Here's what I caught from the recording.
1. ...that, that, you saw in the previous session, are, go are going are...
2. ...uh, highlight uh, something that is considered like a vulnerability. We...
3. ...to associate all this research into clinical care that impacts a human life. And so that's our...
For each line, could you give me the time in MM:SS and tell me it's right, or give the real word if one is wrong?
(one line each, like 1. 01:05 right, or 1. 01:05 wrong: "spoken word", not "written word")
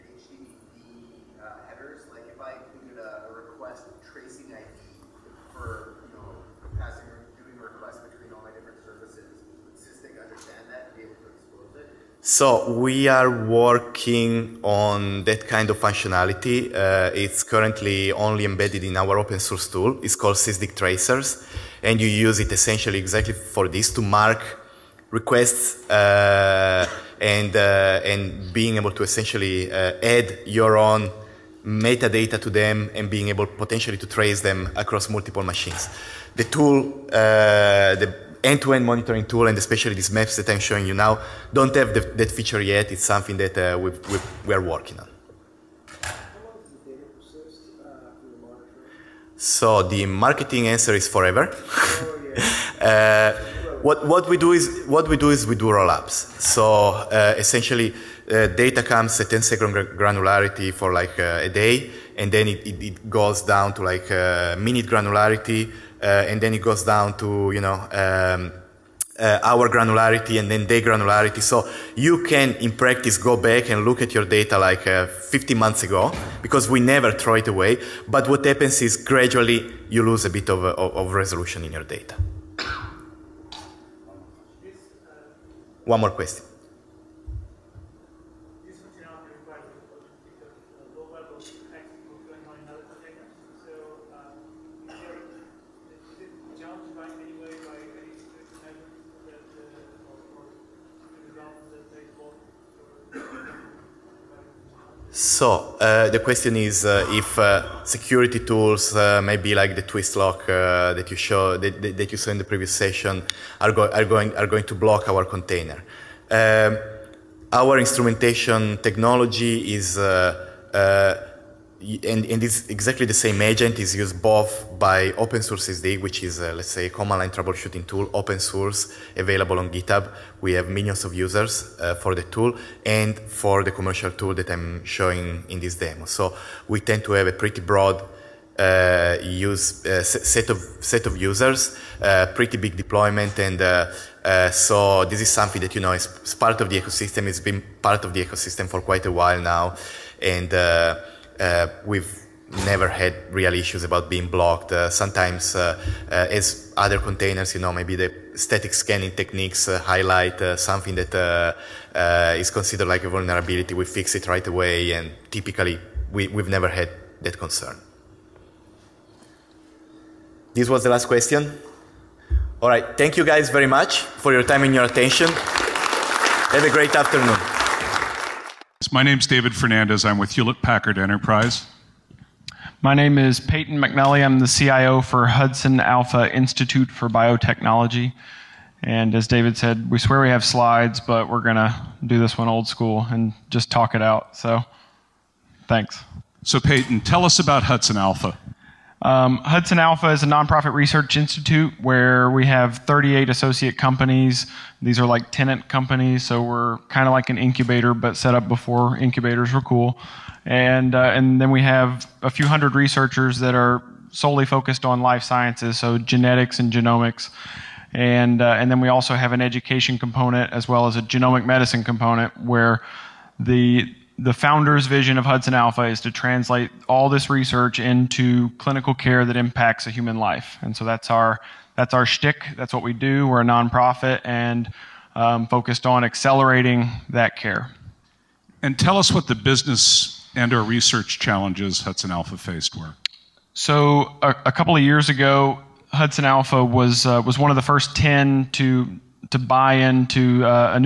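1. 01:51 right
2. 02:39 right
3. 03:46 wrong: "translate", not "associate".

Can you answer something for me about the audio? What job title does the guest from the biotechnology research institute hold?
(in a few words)
CIO.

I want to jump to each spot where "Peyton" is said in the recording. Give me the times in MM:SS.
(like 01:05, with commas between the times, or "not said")
03:03, 03:16.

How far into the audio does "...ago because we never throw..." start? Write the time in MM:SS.
01:15.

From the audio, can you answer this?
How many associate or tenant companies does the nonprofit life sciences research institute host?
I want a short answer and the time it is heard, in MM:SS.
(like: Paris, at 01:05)
38, at 03:22.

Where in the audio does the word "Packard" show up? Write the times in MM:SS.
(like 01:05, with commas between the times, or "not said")
03:00.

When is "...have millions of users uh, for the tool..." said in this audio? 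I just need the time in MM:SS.
02:10.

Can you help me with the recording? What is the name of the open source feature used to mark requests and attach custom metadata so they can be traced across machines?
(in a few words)
Sysdig Tracers.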